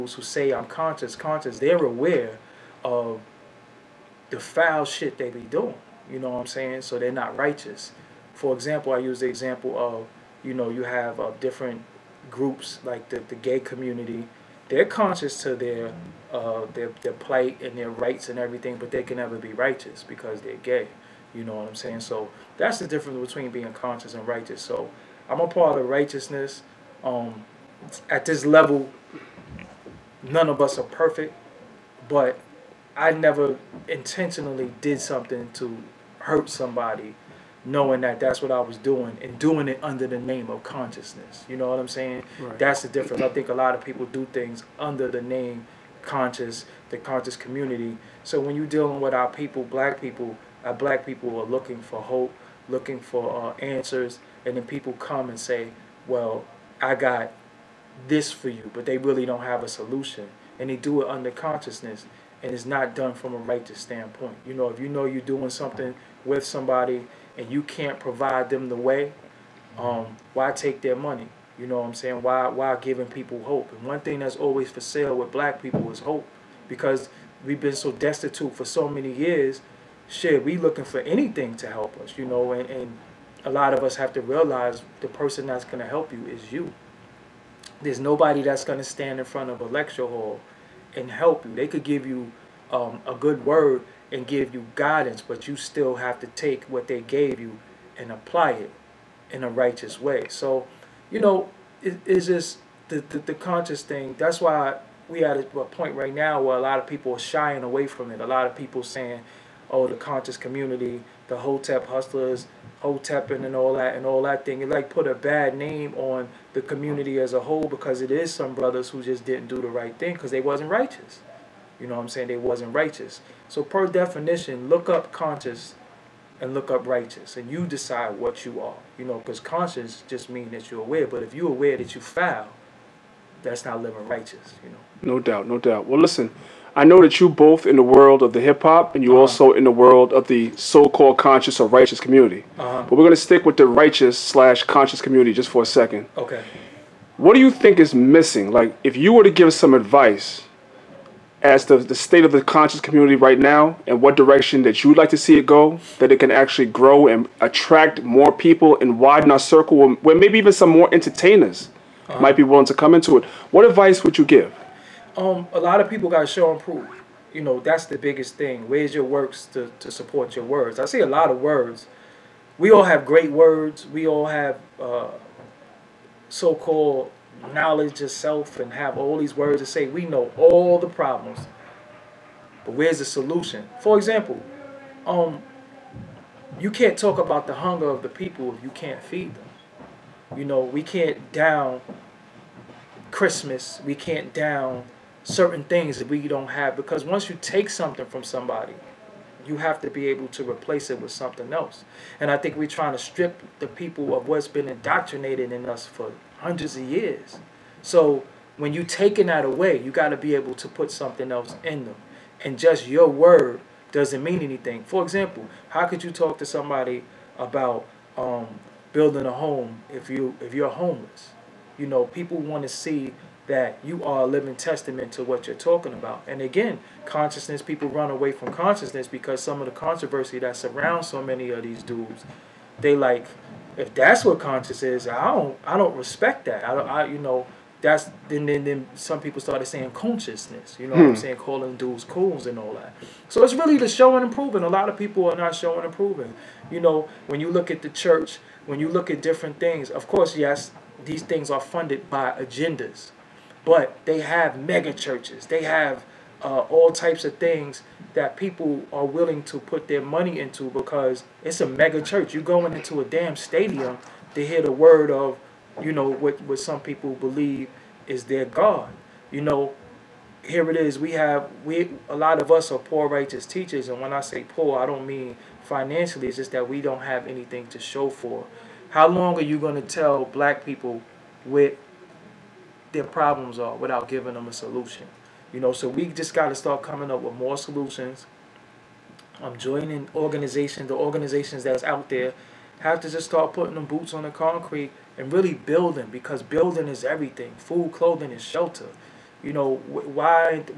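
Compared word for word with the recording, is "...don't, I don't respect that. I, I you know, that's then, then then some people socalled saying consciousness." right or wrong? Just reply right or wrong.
wrong.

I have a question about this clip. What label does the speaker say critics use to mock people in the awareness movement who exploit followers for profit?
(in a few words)
Hotep hustlers.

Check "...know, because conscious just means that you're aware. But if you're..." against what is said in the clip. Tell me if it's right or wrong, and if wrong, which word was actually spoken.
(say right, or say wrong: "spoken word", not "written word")
right.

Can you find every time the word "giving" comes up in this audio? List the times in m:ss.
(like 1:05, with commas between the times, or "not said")
1:12, 4:44.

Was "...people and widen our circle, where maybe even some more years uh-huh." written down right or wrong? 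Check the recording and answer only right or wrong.
wrong.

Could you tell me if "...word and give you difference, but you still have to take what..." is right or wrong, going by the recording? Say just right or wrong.
wrong.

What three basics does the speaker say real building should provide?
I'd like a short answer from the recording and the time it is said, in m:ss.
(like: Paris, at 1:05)
Food, clothing, and shelter, at 4:57.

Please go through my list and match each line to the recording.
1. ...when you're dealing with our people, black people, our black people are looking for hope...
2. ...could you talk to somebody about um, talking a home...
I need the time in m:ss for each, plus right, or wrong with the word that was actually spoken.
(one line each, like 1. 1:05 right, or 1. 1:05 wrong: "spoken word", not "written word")
1. 0:48 right
2. 3:35 wrong: "building", not "talking".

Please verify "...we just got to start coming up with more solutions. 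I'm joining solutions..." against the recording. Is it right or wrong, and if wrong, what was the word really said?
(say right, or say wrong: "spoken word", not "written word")
wrong: "organizations", not "solutions".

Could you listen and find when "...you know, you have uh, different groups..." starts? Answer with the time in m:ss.
0:10.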